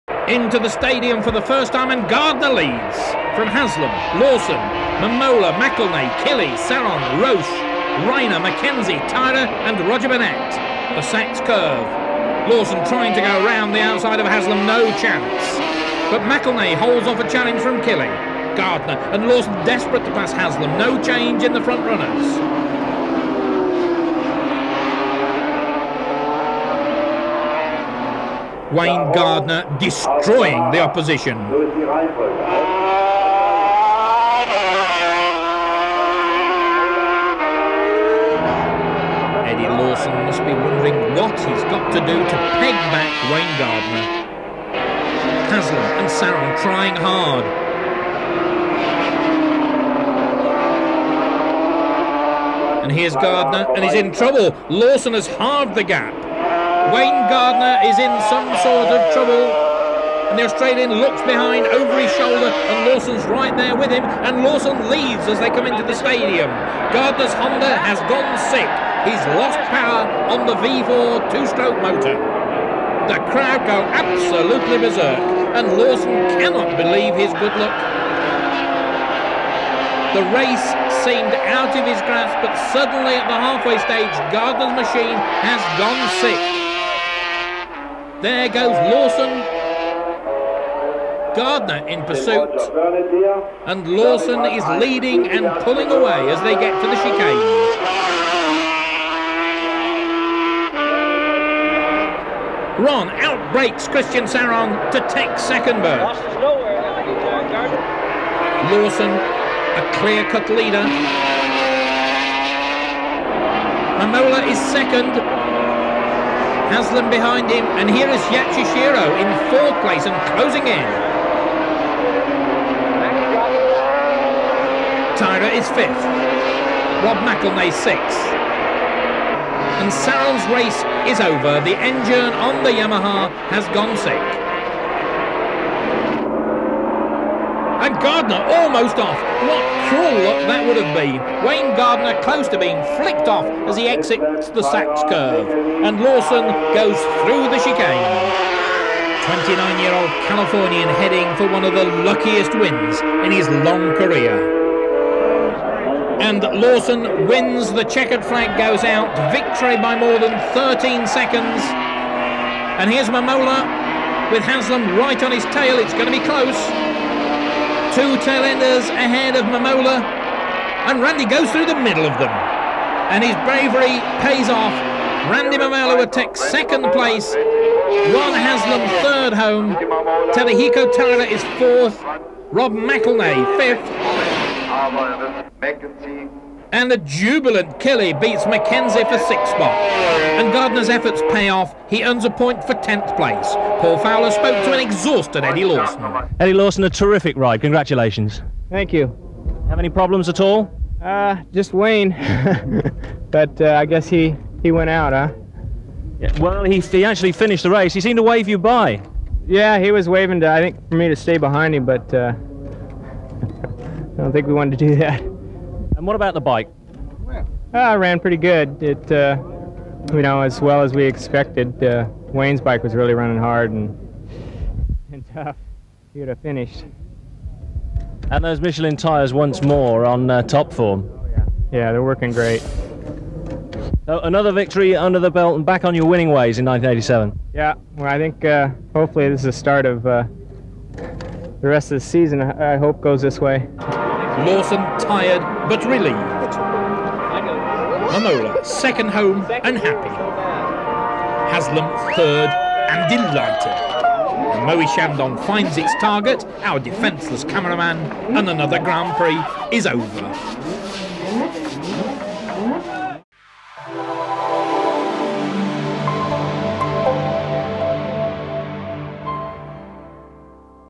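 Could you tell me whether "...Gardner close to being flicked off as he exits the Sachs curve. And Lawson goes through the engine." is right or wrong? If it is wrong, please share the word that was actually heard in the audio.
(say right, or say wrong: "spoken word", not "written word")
wrong: "chicane", not "engine".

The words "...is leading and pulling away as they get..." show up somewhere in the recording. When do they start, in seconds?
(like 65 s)
94 s.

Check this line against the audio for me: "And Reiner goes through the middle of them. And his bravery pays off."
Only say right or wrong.
wrong.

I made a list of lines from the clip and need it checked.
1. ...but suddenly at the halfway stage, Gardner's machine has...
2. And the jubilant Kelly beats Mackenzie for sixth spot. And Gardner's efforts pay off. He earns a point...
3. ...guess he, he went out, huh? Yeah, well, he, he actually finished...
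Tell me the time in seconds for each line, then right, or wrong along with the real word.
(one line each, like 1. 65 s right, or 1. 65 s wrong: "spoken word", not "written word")
1. 82 s right
2. 186 s right
3. 203 s right.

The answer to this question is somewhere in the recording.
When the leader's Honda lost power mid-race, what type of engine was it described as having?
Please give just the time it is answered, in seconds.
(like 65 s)
70 s.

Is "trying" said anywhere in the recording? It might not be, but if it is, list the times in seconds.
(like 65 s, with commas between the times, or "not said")
12 s, 46 s.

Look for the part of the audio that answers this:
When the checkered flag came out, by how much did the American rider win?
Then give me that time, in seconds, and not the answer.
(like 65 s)
159 s.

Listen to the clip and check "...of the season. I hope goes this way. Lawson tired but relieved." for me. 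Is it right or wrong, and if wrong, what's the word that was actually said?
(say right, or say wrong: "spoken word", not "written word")
right.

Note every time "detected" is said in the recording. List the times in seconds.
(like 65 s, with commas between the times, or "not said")
not said.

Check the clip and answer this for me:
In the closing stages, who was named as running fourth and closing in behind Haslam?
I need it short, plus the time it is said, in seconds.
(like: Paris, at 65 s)
Yatsushiro, at 118 s.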